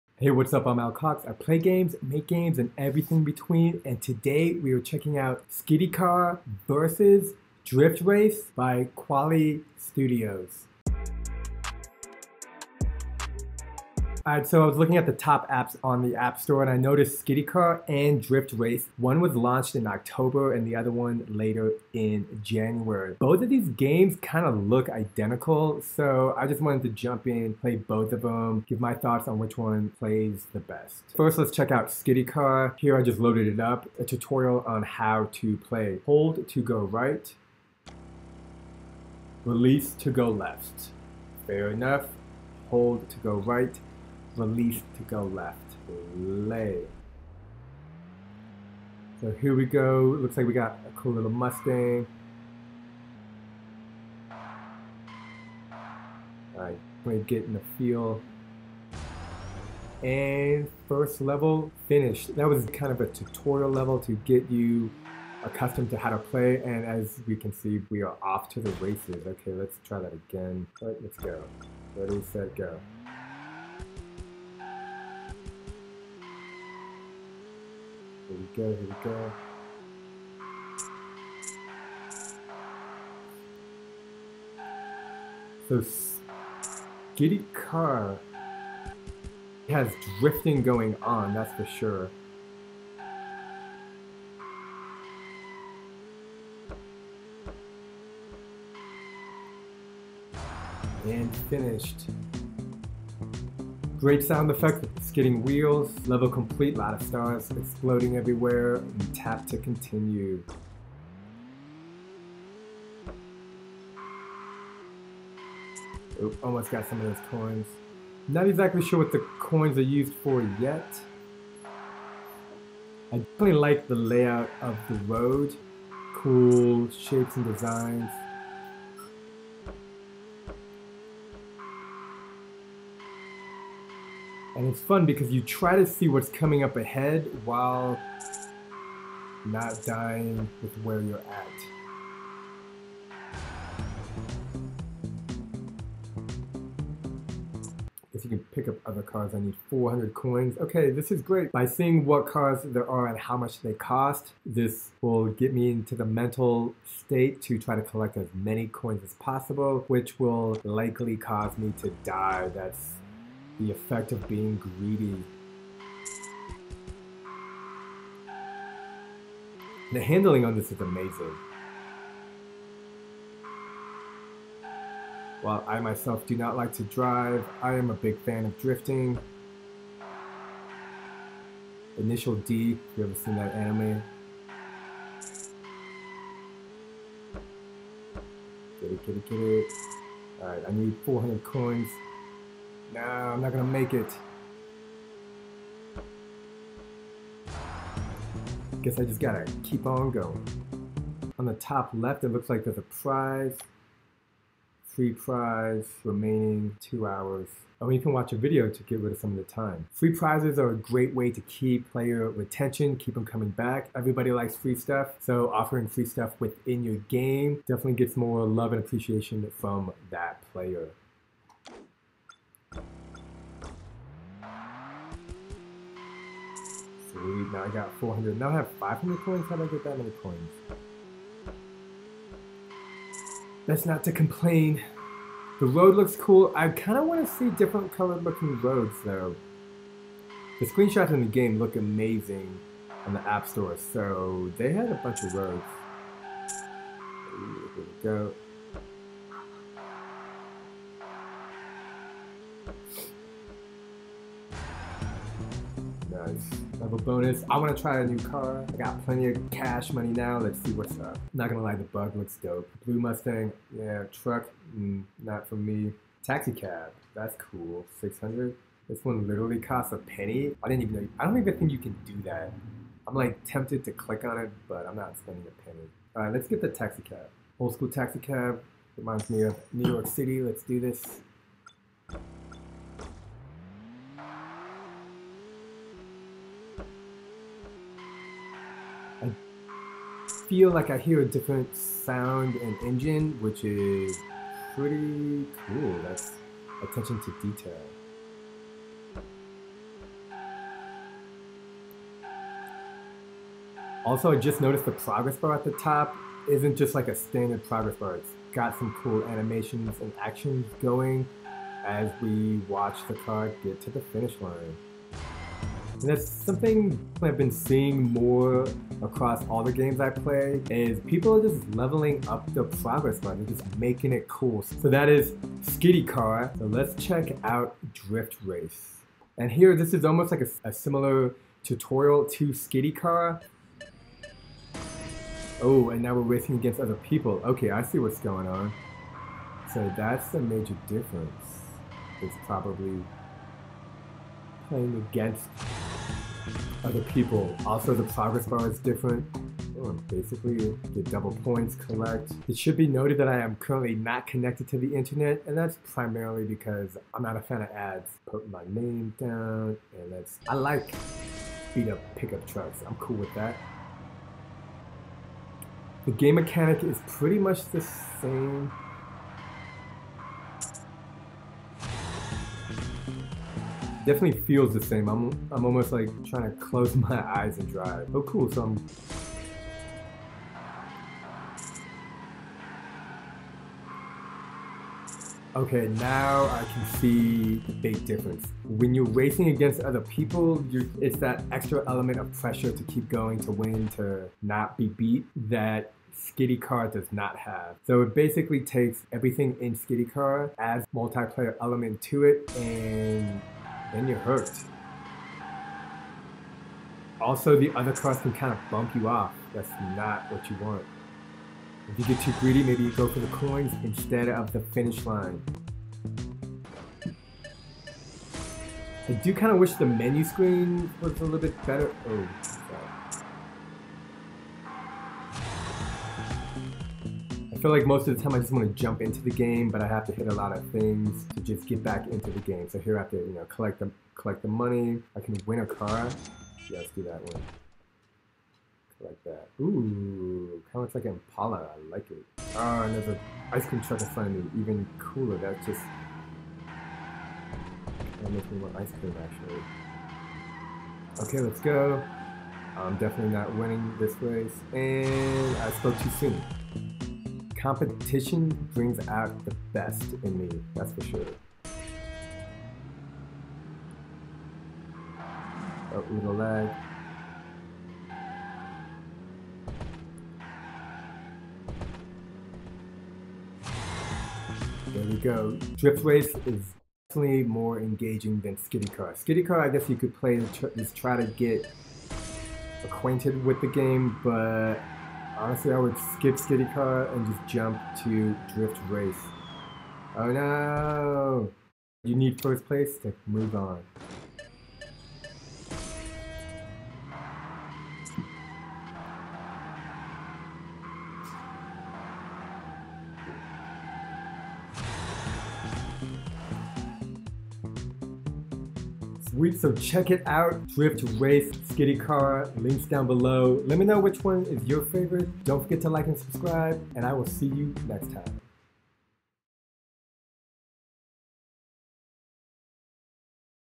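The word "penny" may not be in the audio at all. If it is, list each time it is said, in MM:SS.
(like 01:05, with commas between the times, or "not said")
04:29, 04:35.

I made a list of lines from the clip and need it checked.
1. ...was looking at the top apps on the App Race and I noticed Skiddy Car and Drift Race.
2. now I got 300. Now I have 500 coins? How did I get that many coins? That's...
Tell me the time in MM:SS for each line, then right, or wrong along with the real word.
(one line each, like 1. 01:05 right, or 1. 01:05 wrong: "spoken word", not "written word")
1. 00:14 wrong: "Store", not "Race"
2. 03:47 wrong: "400", not "300".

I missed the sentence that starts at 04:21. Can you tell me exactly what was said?
Not gonna lie, the bug looks dope.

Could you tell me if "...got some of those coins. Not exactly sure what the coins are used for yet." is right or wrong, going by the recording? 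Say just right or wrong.
right.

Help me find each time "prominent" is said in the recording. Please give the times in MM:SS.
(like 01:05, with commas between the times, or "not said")
not said.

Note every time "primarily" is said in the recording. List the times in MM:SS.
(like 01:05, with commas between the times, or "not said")
05:55.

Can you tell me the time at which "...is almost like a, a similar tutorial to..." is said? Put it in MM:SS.
05:29.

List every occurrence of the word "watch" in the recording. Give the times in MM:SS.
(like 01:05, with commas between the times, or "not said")
03:28, 05:12.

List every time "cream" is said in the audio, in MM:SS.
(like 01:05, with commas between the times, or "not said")
07:23, 07:28.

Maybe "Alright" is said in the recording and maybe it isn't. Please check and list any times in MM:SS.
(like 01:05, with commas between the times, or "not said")
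00:56, 03:10.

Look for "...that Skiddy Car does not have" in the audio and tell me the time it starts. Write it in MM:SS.
06:35.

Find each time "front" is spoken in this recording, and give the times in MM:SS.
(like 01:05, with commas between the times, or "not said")
07:24.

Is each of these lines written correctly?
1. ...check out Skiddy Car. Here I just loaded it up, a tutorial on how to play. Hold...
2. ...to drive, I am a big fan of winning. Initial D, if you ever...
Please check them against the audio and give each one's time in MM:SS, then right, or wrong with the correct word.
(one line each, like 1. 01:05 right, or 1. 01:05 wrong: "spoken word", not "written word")
1. 00:31 right
2. 02:56 wrong: "drifting", not "winning".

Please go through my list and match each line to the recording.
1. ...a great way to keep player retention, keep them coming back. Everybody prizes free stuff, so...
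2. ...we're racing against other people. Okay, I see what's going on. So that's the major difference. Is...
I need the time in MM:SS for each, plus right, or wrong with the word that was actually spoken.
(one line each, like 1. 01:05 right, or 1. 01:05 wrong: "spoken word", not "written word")
1. 03:30 wrong: "likes", not "prizes"
2. 05:36 right.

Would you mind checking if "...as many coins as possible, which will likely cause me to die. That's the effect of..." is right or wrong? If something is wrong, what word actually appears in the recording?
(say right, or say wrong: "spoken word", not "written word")
right.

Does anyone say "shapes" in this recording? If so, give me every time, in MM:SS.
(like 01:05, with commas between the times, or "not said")
02:06.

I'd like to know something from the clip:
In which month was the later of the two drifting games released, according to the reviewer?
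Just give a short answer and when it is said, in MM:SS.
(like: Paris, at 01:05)
January, at 00:22.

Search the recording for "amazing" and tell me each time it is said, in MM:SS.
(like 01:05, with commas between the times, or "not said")
02:50, 04:01.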